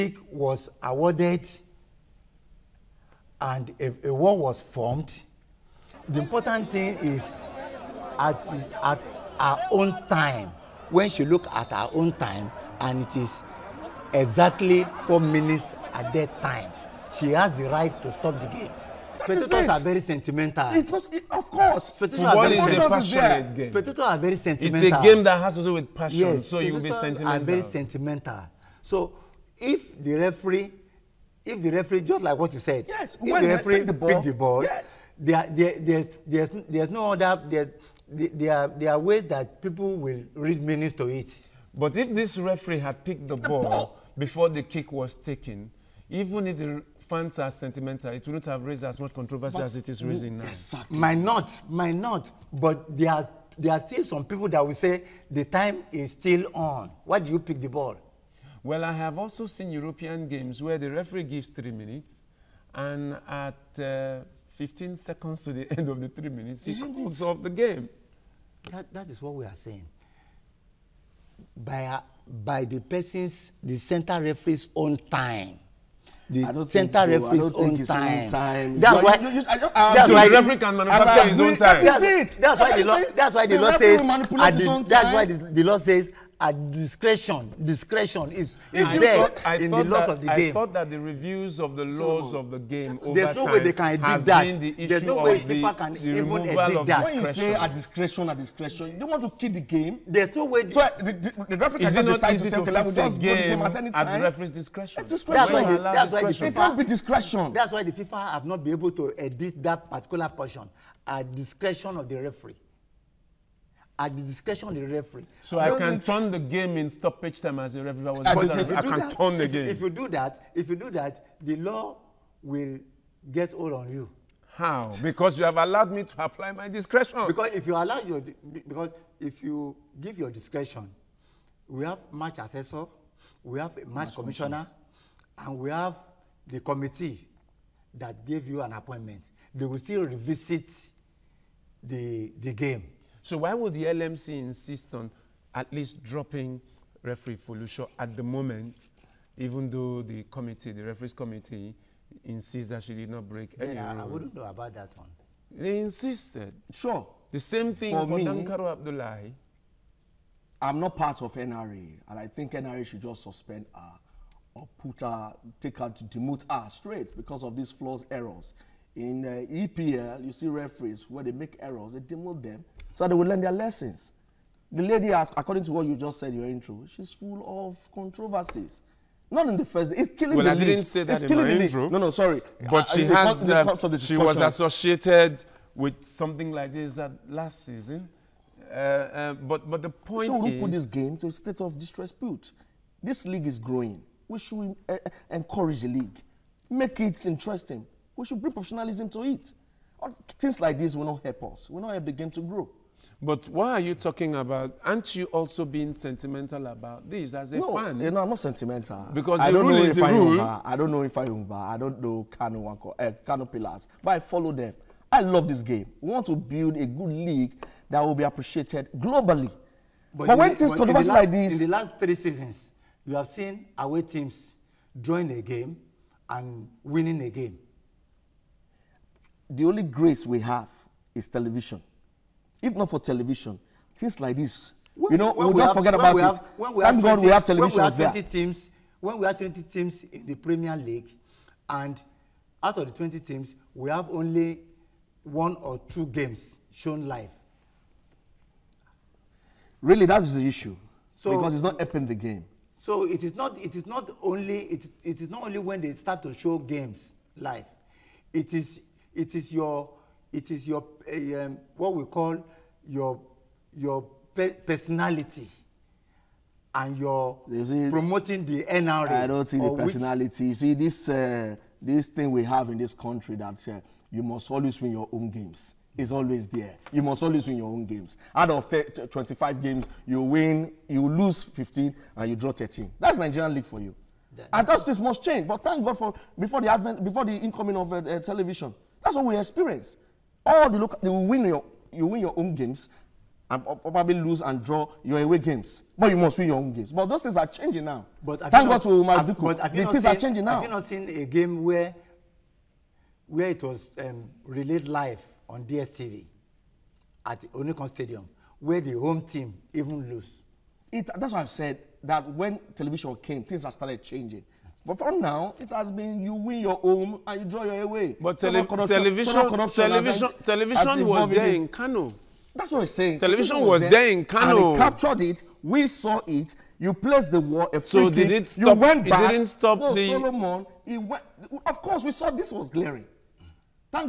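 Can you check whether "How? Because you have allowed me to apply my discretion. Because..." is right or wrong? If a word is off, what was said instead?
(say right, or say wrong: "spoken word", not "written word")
right.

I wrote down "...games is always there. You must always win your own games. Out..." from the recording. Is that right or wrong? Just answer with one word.
right.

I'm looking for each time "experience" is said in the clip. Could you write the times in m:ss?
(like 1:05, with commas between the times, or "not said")
4:49.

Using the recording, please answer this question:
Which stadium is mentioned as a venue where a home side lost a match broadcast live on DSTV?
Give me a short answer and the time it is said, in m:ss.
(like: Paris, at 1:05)
Onikan Stadium, at 5:07.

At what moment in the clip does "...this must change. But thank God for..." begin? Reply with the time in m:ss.
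4:44.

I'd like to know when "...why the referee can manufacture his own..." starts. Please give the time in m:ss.
1:20.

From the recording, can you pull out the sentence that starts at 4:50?
All the local, they will win your, you win your own games and probably lose and draw your away games.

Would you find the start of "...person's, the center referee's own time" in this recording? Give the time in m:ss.
1:12.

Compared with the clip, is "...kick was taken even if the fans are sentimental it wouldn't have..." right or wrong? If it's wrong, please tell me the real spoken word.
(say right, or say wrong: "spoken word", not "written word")
right.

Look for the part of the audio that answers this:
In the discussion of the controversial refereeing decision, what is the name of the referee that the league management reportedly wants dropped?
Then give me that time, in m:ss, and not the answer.
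2:27.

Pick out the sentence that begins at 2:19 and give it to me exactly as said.
They will still revisit the the game.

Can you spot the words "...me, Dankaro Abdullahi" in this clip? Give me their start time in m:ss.
2:38.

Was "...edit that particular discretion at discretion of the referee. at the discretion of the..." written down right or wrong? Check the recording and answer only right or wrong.
wrong.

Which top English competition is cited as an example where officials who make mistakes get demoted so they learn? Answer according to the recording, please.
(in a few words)
EPL.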